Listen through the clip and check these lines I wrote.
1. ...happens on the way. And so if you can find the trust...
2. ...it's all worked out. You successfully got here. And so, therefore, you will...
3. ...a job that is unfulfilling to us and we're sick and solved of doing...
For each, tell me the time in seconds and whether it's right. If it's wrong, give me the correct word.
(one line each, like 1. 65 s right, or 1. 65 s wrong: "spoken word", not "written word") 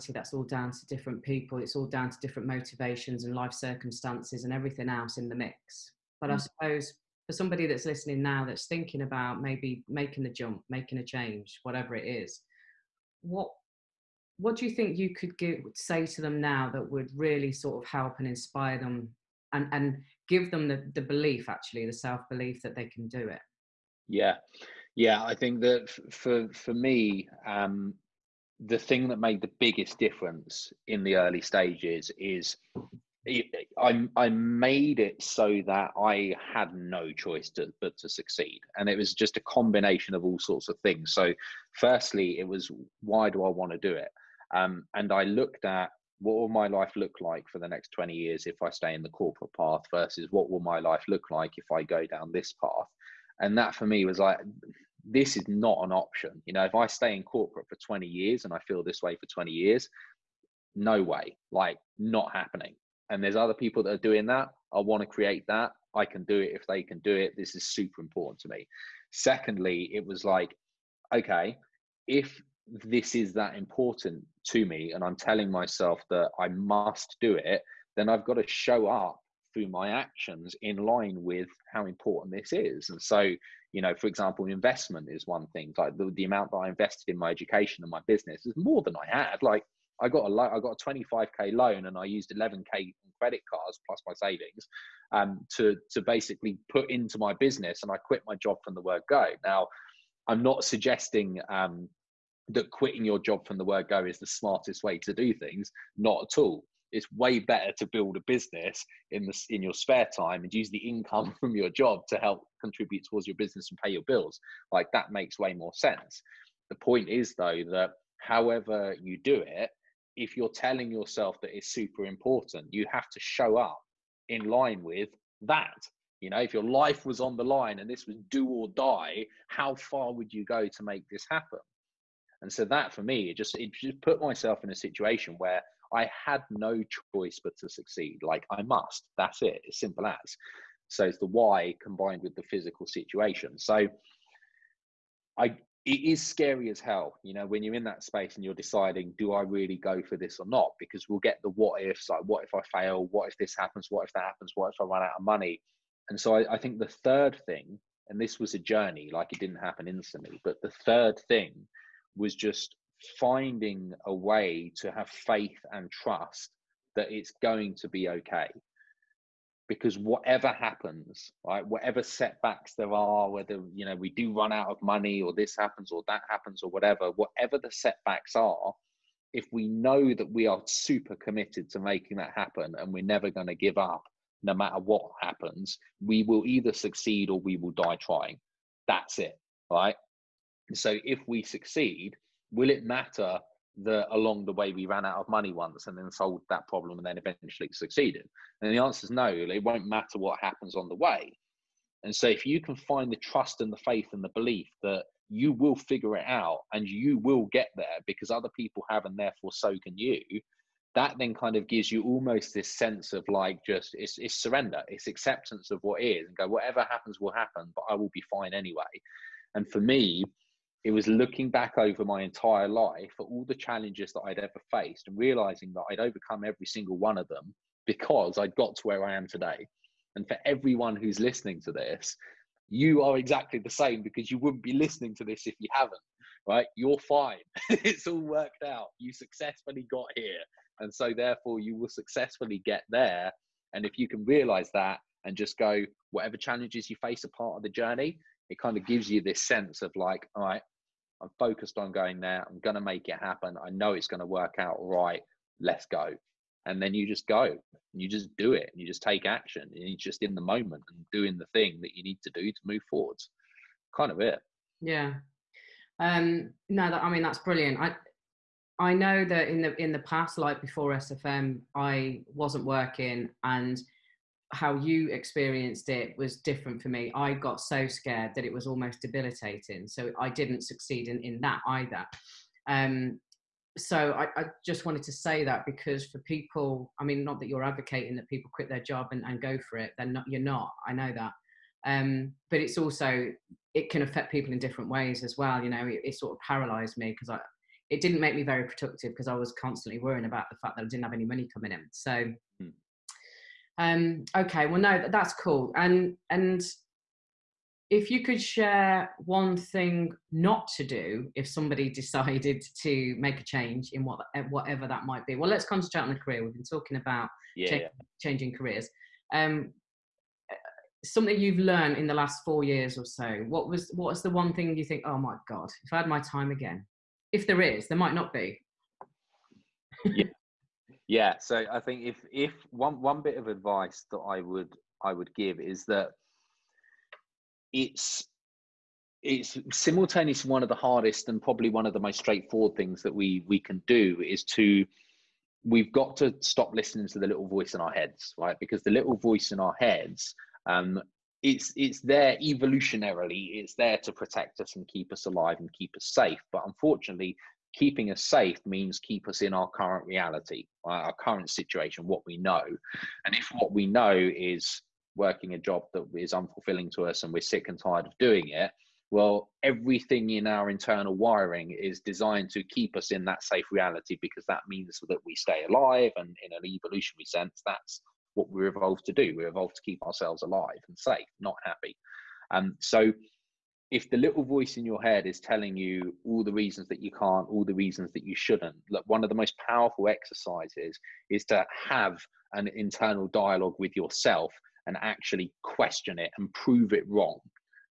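1. 200 s right
2. 237 s right
3. 365 s wrong: "tired", not "solved".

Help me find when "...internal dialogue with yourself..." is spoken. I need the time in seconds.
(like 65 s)
392 s.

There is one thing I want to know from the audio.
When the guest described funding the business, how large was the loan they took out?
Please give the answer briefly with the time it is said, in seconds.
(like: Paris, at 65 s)
25k, at 90 s.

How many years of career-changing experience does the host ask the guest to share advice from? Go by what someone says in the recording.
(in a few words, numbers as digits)
4 years.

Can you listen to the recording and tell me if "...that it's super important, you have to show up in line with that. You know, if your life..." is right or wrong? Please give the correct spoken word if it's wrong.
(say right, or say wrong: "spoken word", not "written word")
right.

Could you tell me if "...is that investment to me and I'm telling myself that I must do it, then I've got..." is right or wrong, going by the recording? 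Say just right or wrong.
wrong.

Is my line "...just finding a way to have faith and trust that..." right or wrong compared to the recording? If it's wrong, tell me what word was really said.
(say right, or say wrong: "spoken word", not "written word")
right.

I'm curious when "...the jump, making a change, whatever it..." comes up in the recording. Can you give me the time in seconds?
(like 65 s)
10 s.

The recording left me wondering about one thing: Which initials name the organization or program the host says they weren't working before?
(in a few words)
SFM.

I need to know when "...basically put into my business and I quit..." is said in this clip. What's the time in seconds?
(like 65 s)
96 s.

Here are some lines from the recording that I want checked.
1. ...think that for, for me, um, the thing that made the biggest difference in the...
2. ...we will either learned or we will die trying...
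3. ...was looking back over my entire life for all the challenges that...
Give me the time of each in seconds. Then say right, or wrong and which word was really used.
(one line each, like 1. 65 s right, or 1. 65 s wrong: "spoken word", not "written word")
1. 25 s right
2. 186 s wrong: "succeed", not "learned"
3. 220 s right.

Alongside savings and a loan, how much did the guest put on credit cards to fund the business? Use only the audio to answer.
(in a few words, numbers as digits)
11k.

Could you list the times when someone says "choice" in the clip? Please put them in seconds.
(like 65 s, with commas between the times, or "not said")
37 s, 137 s.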